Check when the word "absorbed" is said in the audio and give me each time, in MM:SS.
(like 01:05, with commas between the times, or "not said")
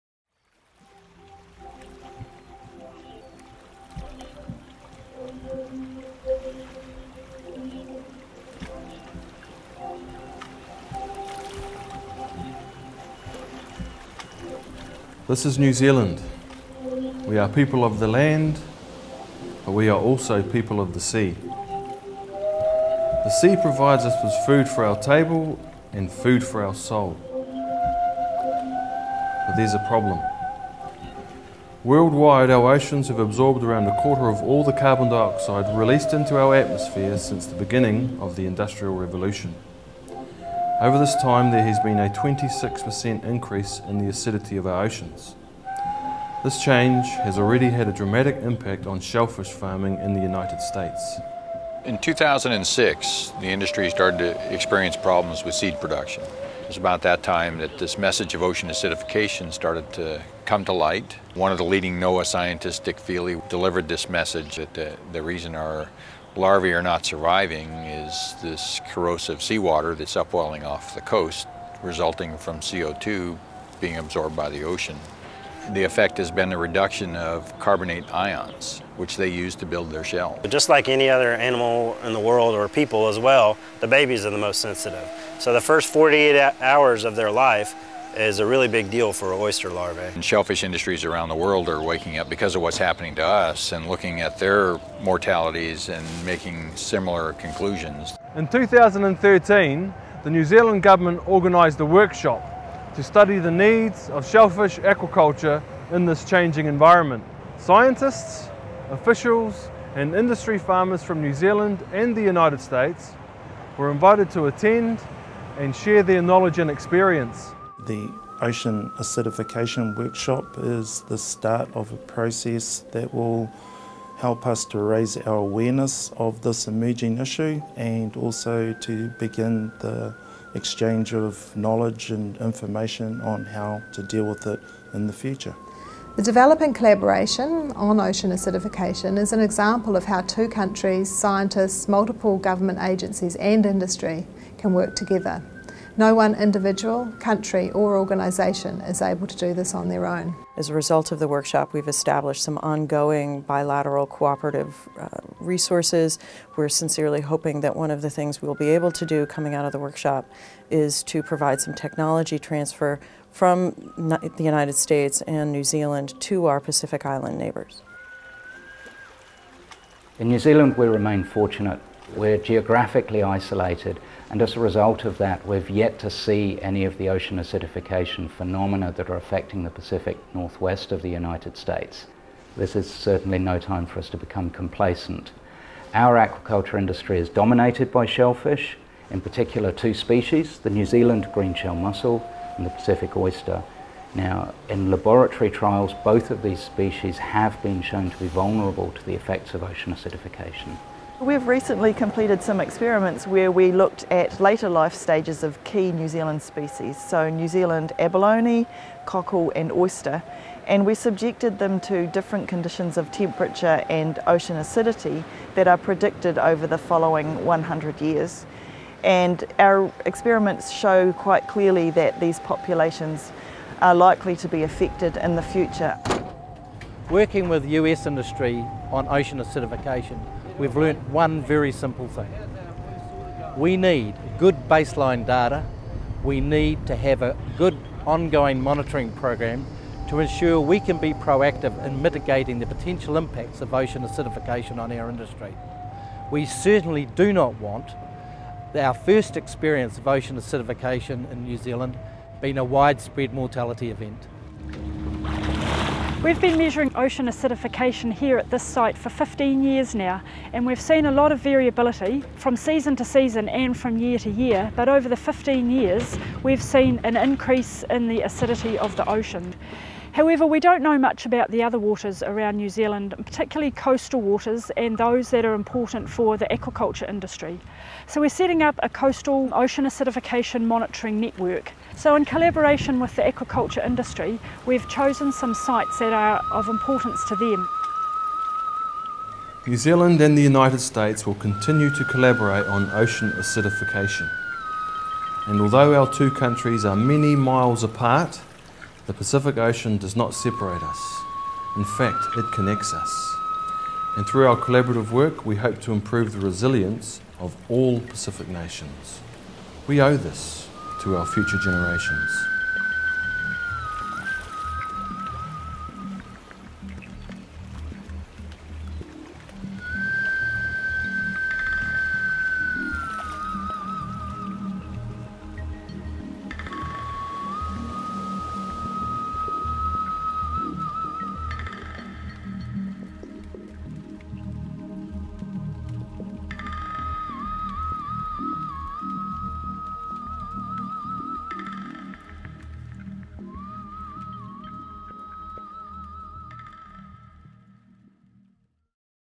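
00:33, 01:13.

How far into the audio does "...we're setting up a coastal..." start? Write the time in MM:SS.
04:38.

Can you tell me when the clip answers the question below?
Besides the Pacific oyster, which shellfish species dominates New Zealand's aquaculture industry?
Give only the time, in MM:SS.
03:10.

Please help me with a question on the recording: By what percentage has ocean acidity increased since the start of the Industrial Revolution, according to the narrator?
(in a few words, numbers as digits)
26%.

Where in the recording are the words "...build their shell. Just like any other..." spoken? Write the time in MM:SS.
01:19.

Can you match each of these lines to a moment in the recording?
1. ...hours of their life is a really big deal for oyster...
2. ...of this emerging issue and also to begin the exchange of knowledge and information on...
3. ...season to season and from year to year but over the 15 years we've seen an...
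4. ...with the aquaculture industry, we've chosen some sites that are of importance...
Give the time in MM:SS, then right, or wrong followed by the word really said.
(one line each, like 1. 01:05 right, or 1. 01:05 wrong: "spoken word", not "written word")
1. 01:26 right
2. 02:06 right
3. 04:22 right
4. 04:42 right.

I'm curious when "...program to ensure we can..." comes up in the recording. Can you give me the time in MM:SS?
03:59.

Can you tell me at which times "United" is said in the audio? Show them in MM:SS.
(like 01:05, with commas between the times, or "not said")
00:50, 01:52, 02:44, 03:01, 04:50.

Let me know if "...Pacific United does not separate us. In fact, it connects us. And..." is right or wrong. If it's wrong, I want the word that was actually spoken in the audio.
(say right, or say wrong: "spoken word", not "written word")
wrong: "Ocean", not "United".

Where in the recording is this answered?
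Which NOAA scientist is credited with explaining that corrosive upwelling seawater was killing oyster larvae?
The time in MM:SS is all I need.
01:02.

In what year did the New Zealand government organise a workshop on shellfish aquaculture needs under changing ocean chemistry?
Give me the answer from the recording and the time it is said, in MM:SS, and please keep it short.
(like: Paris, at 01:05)
2013, at 01:38.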